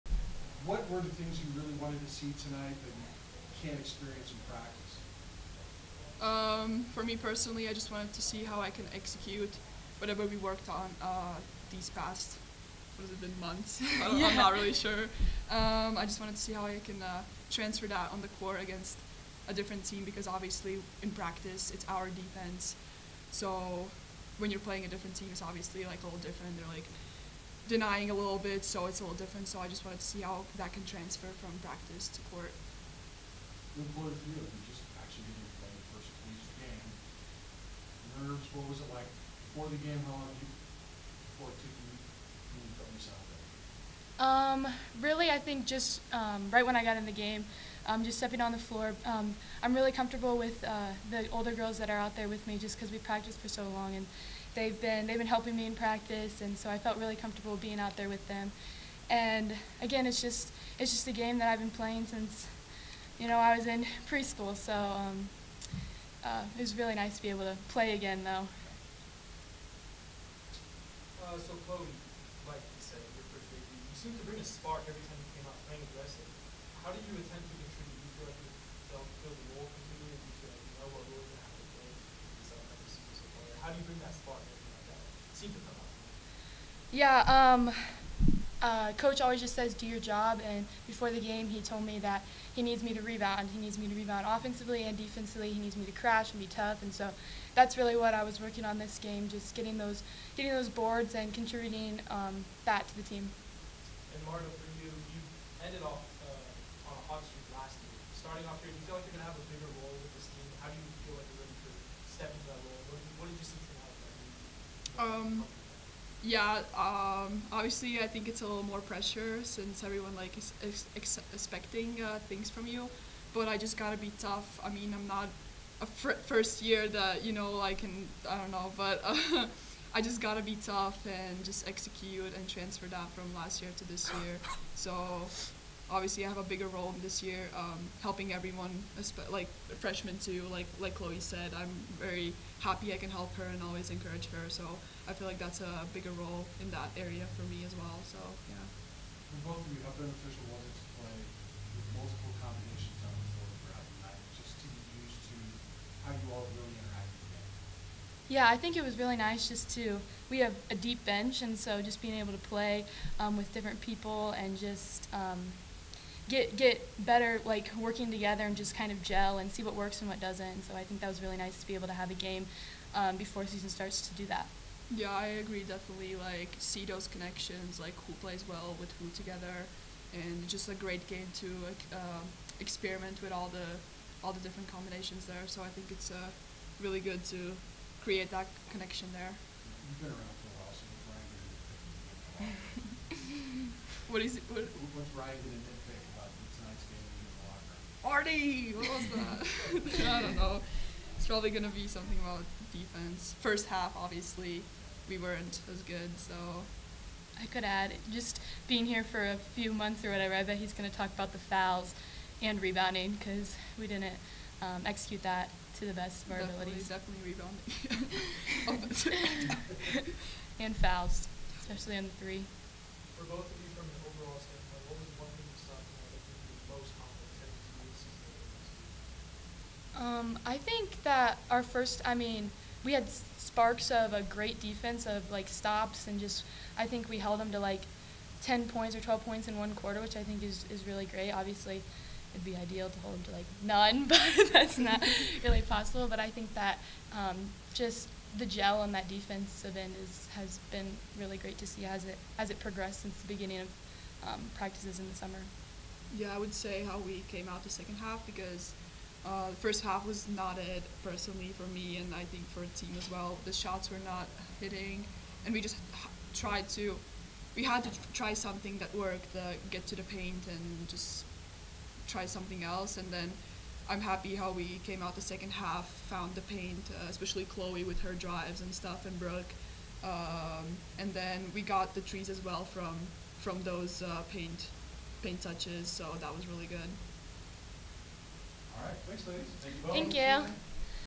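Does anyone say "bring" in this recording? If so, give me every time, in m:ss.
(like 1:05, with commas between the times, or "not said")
1:14, 1:23.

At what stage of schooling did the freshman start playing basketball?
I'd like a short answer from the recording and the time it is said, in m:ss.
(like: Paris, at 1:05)
Preschool, at 1:04.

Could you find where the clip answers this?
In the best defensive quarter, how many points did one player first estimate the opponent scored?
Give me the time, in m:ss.
3:58.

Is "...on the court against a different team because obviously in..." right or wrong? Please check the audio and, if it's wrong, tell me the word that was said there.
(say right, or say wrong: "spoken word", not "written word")
right.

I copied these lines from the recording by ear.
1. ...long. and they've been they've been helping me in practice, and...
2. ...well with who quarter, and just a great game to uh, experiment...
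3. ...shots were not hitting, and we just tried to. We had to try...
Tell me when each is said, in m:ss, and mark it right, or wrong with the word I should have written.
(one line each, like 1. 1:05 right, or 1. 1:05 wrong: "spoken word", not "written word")
1. 0:53 right
2. 2:58 wrong: "together", not "quarter"
3. 4:23 right.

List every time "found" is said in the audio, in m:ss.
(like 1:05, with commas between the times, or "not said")
4:36.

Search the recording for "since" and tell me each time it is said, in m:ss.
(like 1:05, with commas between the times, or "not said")
1:02, 1:59, 4:13.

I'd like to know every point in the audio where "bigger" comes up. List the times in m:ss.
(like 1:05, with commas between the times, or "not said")
2:16, 2:25.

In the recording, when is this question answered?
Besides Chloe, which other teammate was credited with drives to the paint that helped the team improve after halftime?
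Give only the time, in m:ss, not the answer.
4:39.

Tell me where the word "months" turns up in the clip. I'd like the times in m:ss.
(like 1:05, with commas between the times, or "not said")
0:13, 3:29.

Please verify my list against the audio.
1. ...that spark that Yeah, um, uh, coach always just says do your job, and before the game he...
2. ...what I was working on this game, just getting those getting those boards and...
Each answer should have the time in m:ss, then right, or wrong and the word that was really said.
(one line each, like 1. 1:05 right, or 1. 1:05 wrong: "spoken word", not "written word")
1. 1:23 right
2. 1:37 right.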